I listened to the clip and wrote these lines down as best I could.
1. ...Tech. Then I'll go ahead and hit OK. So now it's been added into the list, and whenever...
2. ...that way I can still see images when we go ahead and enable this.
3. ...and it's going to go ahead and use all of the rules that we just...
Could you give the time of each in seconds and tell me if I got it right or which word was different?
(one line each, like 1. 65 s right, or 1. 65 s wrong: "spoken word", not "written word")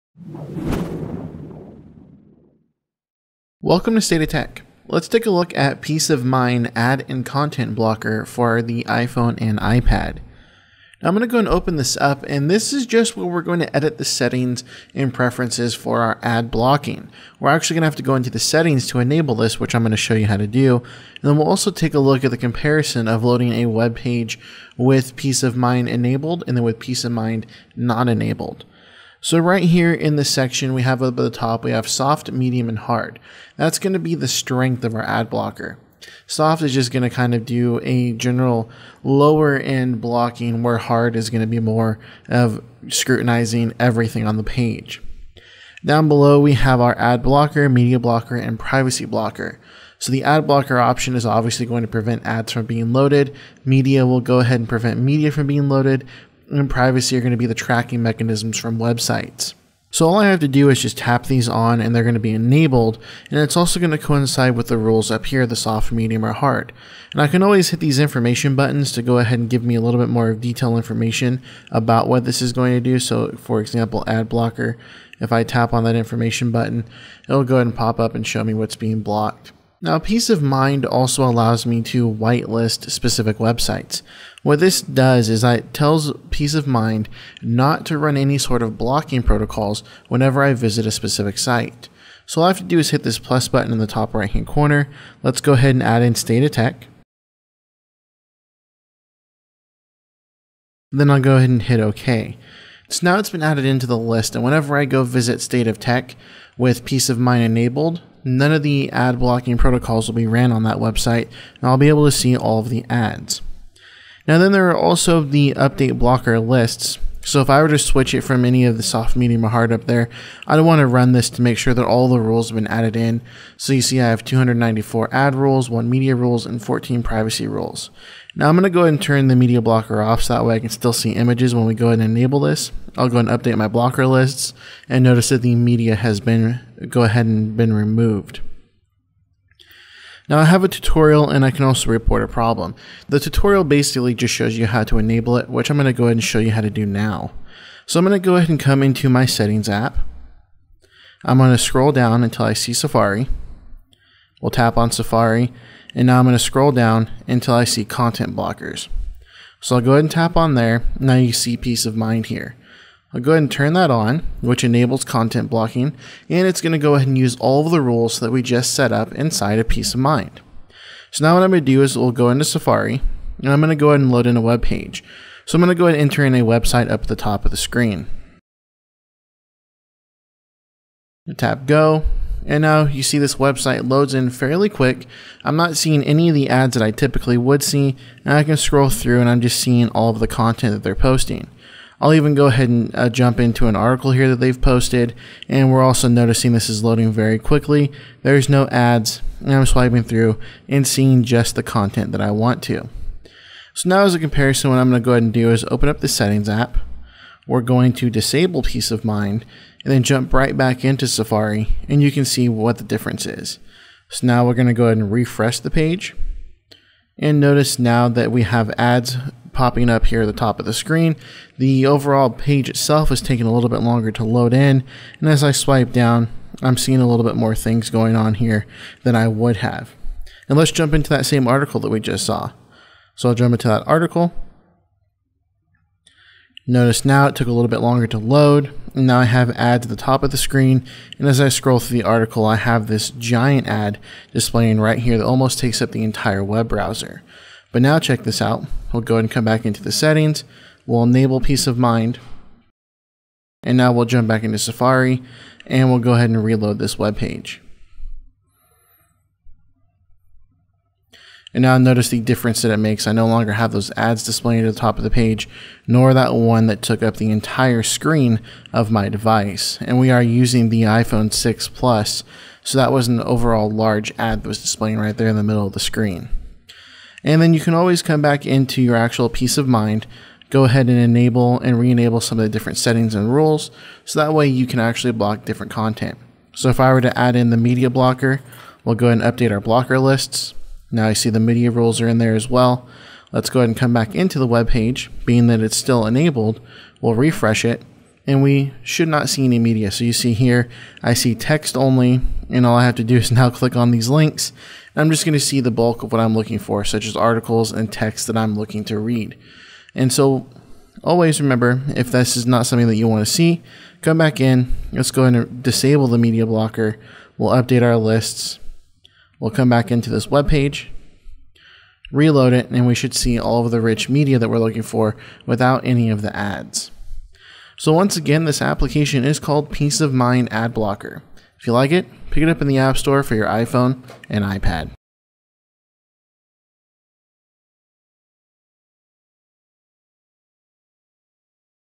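1. 96 s right
2. 130 s right
3. 166 s right.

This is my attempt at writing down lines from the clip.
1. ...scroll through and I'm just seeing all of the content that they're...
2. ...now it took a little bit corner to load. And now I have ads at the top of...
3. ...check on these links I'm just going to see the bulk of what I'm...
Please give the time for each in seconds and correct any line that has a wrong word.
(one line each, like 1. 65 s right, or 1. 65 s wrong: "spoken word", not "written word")
1. 188 s right
2. 237 s wrong: "longer", not "corner"
3. 303 s wrong: "click", not "check".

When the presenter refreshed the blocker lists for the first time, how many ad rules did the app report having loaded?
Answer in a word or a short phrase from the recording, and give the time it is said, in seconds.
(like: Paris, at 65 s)
294, at 124 s.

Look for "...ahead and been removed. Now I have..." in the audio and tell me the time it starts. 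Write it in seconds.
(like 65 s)
137 s.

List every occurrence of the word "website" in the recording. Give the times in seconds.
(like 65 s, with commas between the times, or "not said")
58 s, 83 s, 110 s, 176 s, 183 s.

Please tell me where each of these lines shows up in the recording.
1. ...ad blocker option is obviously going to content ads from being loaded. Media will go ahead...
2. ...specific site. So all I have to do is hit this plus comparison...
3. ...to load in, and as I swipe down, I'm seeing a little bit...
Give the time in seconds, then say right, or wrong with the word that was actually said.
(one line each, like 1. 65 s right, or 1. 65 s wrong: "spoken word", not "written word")
1. 50 s wrong: "prevent", not "content"
2. 90 s wrong: "button", not "comparison"
3. 224 s right.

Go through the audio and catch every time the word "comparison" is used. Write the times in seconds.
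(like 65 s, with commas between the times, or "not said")
22 s, 204 s.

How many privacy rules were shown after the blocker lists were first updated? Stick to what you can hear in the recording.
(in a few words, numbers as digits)
14.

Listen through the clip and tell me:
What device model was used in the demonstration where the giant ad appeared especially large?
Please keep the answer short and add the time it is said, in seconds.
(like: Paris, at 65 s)
iPhone 6 Plus, at 270 s.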